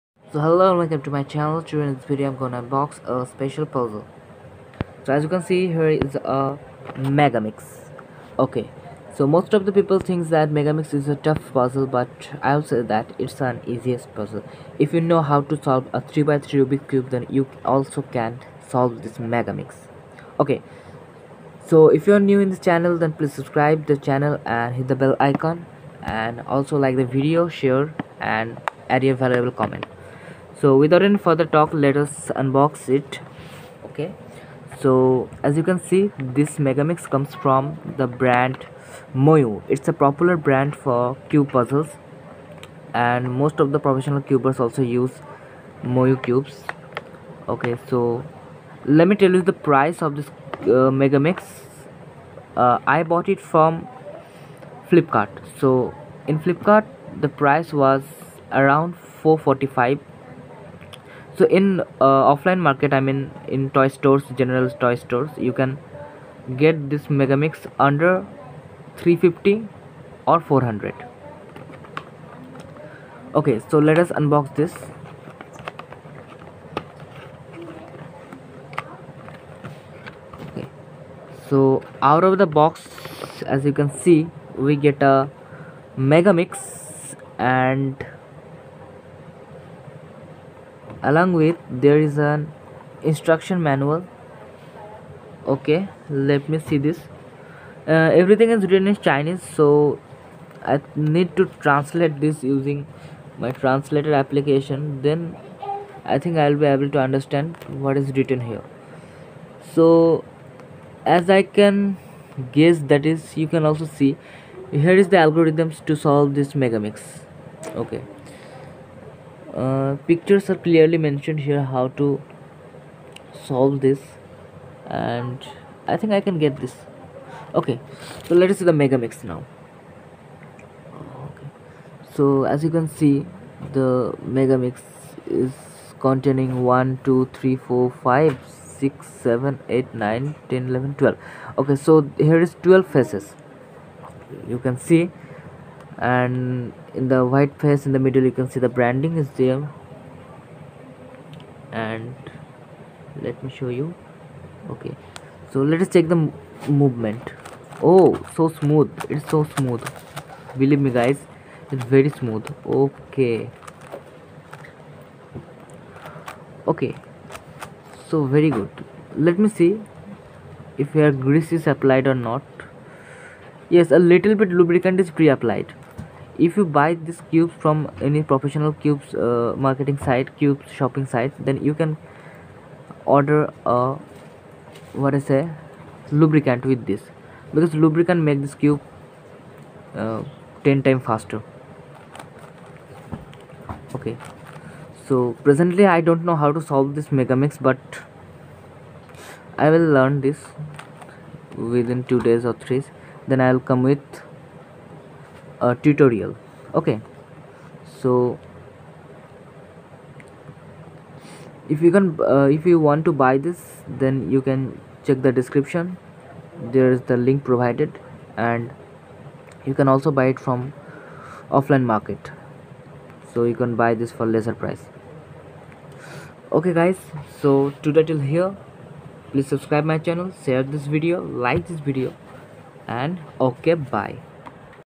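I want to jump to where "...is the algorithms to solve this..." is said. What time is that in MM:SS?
01:55.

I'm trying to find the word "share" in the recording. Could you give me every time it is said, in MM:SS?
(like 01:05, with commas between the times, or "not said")
00:27, 03:50.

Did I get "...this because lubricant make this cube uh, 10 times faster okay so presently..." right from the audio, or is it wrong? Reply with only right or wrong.
right.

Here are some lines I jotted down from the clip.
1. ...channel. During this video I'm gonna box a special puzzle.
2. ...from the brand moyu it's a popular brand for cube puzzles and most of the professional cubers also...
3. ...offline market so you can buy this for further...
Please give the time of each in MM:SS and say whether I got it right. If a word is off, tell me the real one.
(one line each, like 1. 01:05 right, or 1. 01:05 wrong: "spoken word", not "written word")
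1. 00:01 right
2. 00:37 right
3. 03:41 wrong: "lesser", not "further".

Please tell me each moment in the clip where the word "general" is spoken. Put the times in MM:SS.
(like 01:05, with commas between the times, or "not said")
01:04.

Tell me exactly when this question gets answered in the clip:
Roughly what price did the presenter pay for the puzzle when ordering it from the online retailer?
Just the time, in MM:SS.
00:59.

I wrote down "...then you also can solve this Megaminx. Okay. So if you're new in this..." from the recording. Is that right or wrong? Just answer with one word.
right.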